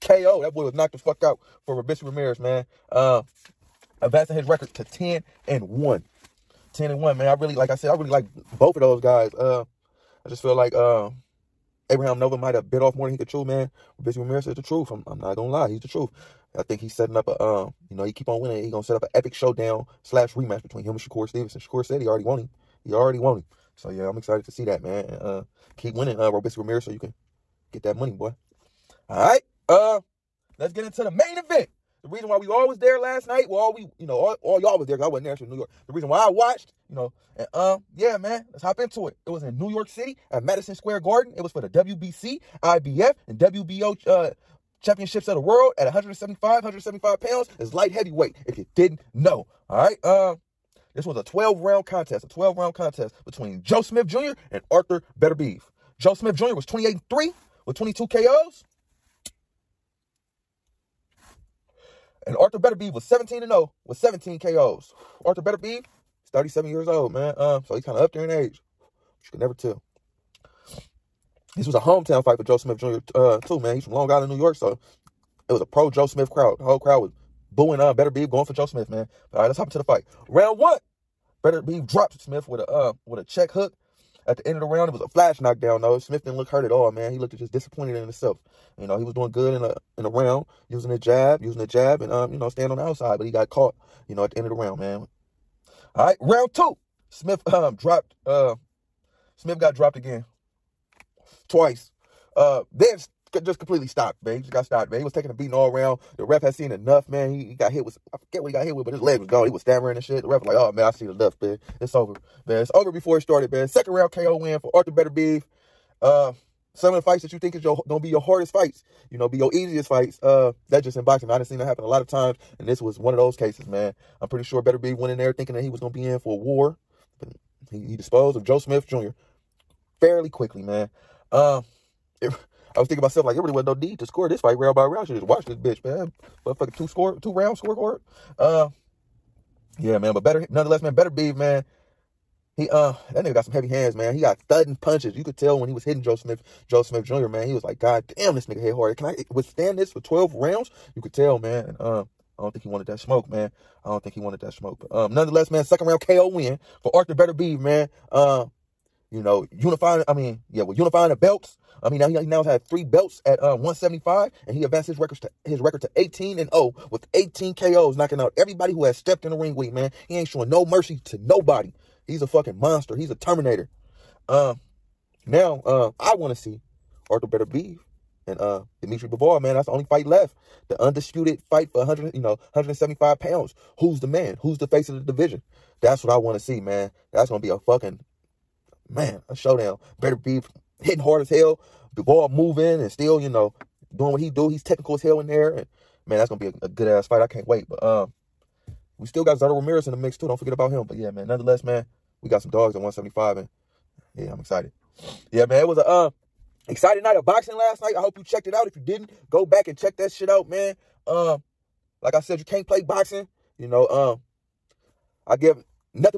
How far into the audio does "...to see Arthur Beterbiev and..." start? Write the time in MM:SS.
02:56.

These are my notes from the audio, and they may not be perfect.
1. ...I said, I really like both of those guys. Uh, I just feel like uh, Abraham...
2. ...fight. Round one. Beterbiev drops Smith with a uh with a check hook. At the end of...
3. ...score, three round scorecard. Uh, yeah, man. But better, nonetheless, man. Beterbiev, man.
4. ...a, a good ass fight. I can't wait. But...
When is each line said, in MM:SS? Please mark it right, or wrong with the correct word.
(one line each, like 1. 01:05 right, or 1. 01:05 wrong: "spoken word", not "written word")
1. 00:07 right
2. 01:19 right
3. 02:16 wrong: "two", not "three"
4. 03:16 right.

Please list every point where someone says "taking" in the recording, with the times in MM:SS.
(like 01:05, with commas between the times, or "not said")
01:45.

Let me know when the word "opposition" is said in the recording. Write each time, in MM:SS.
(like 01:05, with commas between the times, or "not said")
not said.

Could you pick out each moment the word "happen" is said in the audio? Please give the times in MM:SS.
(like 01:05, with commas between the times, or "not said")
02:01.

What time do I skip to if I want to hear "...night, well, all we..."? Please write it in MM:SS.
00:33.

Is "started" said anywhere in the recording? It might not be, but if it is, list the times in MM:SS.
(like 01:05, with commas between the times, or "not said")
01:53.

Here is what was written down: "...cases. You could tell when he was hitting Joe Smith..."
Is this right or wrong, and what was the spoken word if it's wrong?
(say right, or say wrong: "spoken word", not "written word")
wrong: "punches", not "cases".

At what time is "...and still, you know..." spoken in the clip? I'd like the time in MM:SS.
03:12.